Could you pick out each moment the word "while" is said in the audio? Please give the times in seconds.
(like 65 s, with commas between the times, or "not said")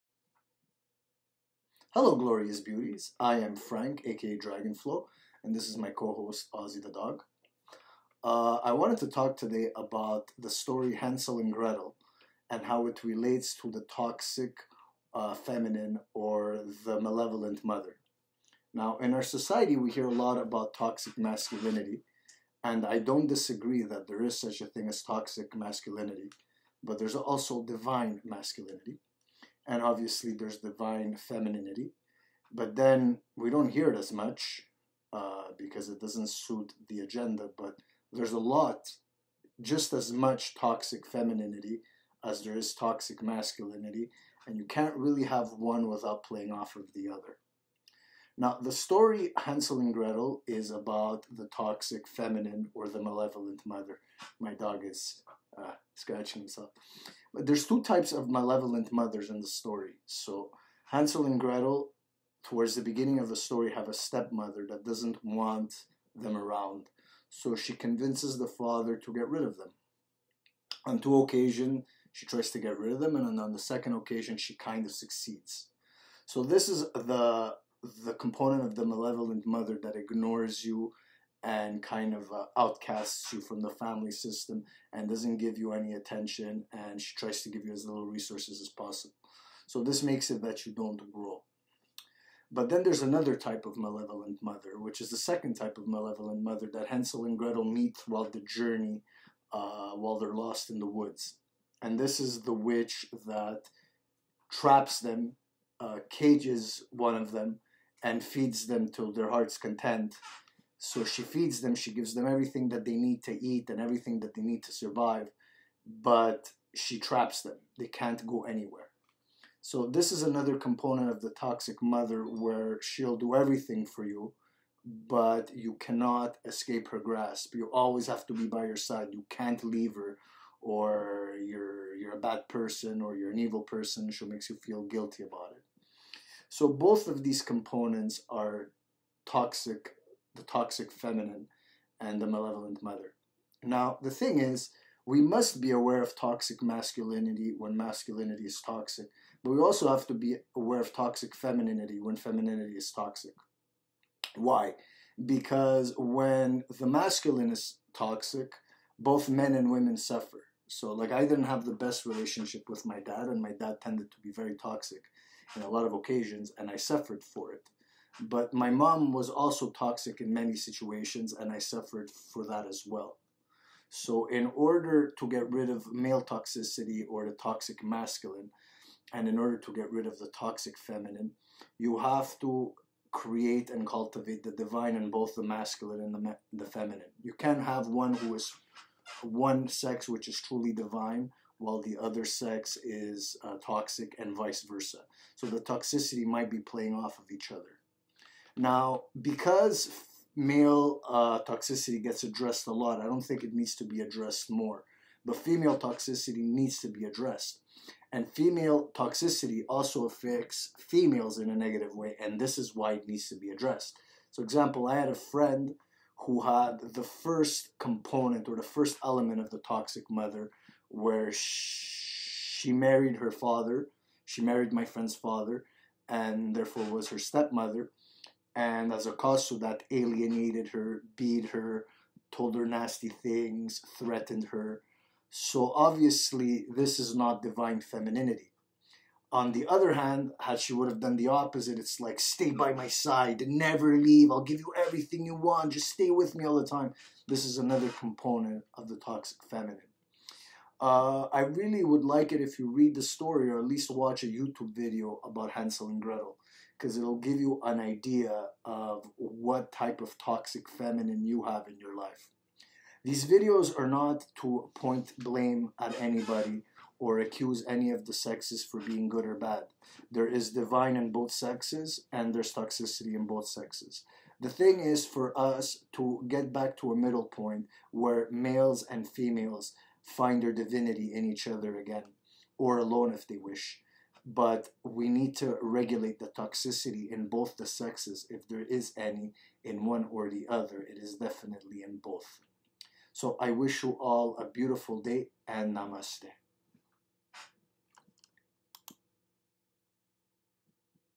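99 s, 191 s.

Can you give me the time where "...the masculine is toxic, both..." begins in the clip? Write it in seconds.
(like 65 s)
156 s.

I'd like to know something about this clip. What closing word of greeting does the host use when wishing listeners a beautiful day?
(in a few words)
Namaste.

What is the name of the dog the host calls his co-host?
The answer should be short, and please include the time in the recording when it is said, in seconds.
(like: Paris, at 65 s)
Ozzy, at 6 s.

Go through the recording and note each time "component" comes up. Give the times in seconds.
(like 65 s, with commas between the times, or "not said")
78 s, 120 s, 137 s, 217 s, 247 s.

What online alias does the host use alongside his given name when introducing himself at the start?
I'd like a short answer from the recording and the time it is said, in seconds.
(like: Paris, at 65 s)
Dragonflow, at 4 s.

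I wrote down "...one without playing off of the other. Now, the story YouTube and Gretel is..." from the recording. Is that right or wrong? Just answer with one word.
wrong.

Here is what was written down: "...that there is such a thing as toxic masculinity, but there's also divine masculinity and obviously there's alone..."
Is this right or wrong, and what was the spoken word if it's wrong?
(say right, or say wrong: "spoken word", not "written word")
wrong: "divine", not "alone".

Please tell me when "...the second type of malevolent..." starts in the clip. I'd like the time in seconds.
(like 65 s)
95 s.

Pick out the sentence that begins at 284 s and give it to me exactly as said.
But we need to regulate the toxicity in both the sexes, if there is any in one or the other.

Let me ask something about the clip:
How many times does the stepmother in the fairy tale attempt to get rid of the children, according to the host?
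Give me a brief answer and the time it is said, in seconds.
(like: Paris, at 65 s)
2, at 70 s.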